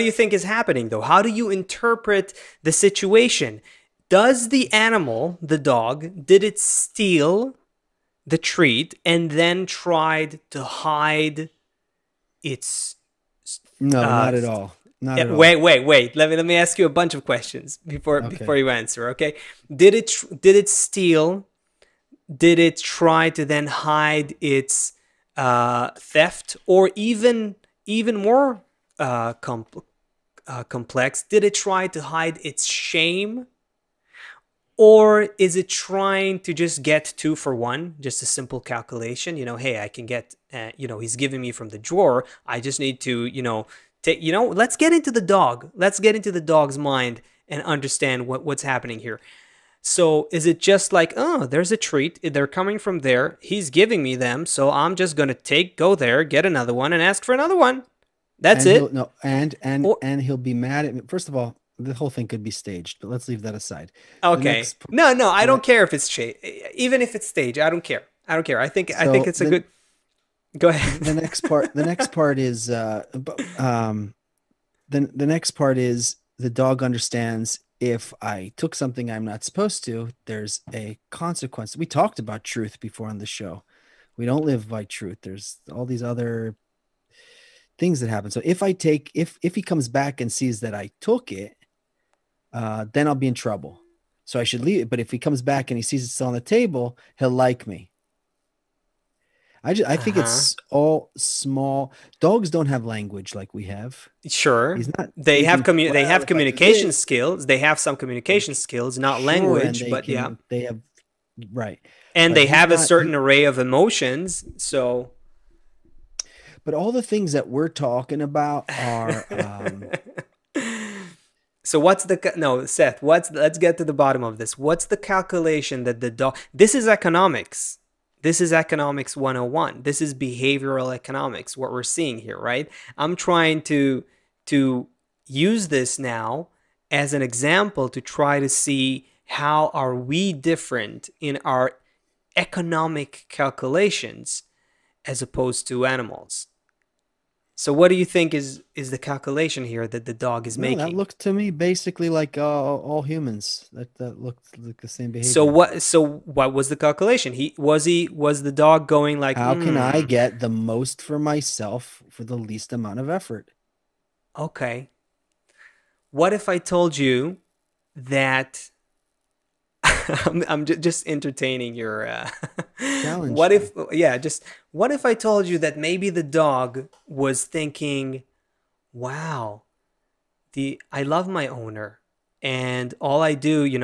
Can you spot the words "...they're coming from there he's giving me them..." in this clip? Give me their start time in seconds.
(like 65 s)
52 s.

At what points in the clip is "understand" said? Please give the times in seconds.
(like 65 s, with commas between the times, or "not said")
47 s, 76 s.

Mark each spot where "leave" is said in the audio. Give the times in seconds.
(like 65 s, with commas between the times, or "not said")
63 s, 94 s.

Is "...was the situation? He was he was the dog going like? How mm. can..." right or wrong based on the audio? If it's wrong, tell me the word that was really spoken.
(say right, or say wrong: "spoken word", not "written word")
wrong: "calculation", not "situation".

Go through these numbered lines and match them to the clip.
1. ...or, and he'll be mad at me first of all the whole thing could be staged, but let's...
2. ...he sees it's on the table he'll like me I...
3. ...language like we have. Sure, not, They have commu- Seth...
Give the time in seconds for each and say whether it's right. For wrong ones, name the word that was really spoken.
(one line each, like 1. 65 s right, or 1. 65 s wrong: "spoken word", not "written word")
1. 59 s right
2. 95 s right
3. 102 s wrong: "They", not "Seth".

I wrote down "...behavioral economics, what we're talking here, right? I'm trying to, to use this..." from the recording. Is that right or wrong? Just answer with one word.
wrong.